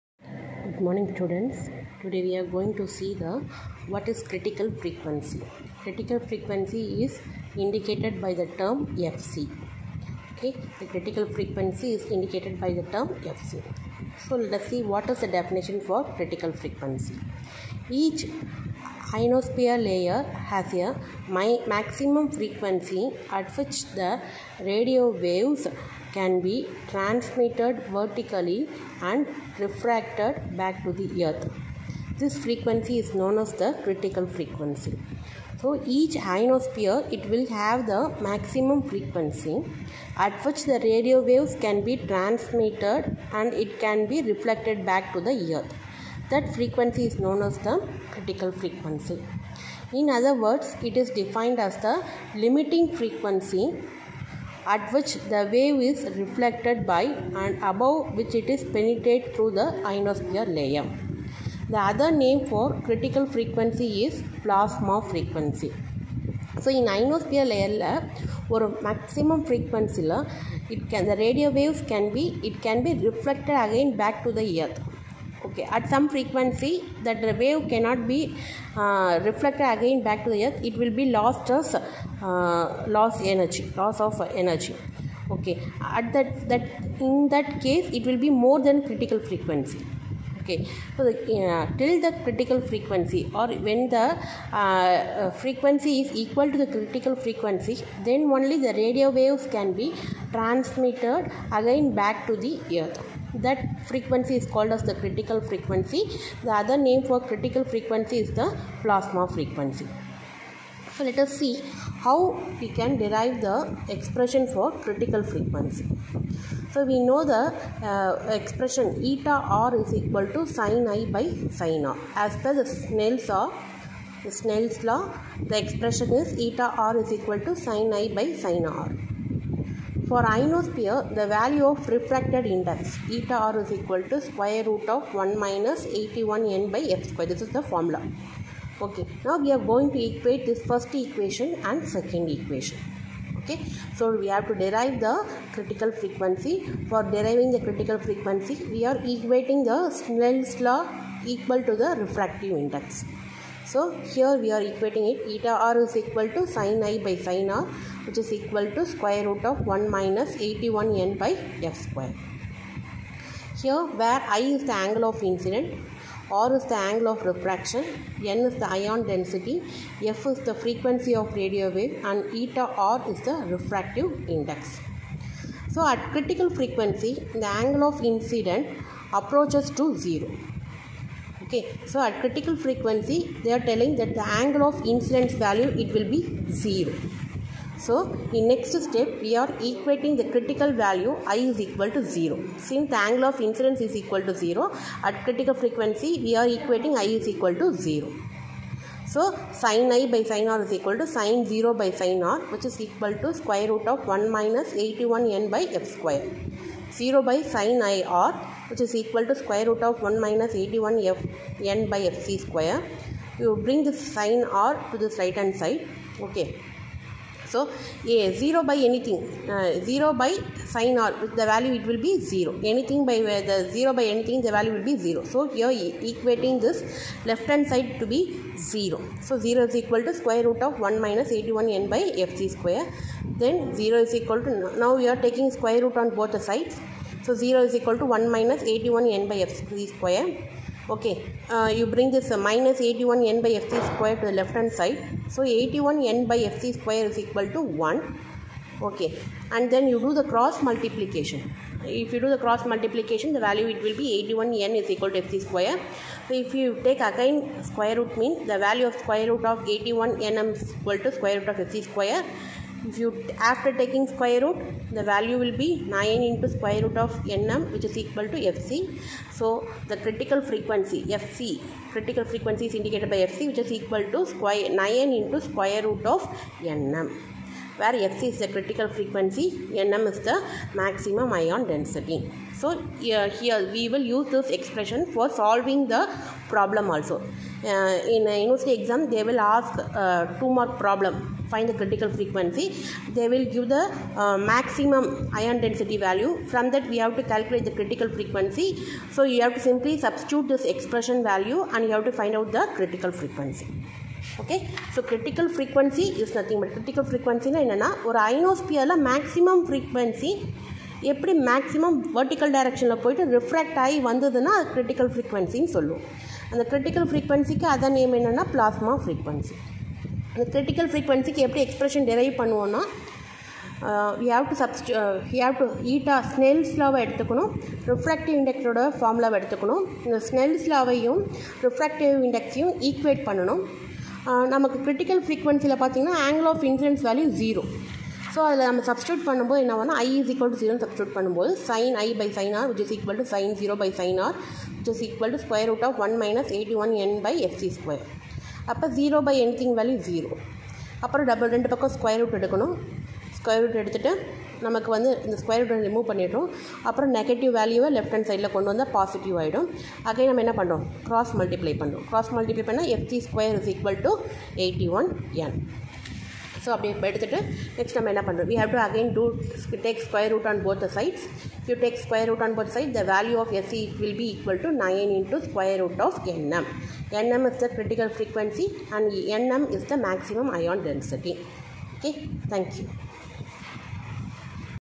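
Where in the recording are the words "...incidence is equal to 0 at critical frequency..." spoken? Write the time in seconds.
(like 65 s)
193 s.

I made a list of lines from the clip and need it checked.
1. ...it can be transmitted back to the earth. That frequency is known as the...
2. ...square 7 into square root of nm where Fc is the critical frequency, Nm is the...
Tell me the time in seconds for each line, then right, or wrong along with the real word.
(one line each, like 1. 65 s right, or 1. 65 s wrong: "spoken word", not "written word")
1. 43 s wrong: "reflected", not "transmitted"
2. 274 s wrong: "9", not "7".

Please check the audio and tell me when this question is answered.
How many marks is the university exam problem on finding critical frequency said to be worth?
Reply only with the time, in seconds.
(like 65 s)
290 s.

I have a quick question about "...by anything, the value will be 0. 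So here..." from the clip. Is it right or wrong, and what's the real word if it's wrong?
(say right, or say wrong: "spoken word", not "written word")
right.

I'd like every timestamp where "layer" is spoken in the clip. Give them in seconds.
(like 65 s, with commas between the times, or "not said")
19 s, 60 s, 67 s.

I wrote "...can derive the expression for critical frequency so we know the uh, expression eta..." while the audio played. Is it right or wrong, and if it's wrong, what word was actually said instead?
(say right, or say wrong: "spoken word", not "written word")
right.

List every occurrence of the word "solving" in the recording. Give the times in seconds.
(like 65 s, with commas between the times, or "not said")
285 s.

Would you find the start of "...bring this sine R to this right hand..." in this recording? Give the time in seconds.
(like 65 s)
213 s.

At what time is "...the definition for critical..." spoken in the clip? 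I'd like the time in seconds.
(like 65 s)
15 s.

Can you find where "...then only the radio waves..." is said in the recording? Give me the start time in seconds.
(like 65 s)
98 s.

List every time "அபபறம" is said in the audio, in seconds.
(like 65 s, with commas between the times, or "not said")
351 s, 356 s.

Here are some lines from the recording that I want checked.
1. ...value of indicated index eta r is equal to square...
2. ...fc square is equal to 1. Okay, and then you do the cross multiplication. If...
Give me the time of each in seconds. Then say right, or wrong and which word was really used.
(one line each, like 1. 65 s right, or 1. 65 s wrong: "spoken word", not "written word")
1. 131 s wrong: "refracted", not "indicated"
2. 246 s right.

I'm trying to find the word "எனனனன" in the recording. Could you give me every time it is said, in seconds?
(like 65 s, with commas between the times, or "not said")
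307 s, 318 s.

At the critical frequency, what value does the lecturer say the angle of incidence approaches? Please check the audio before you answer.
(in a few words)
0.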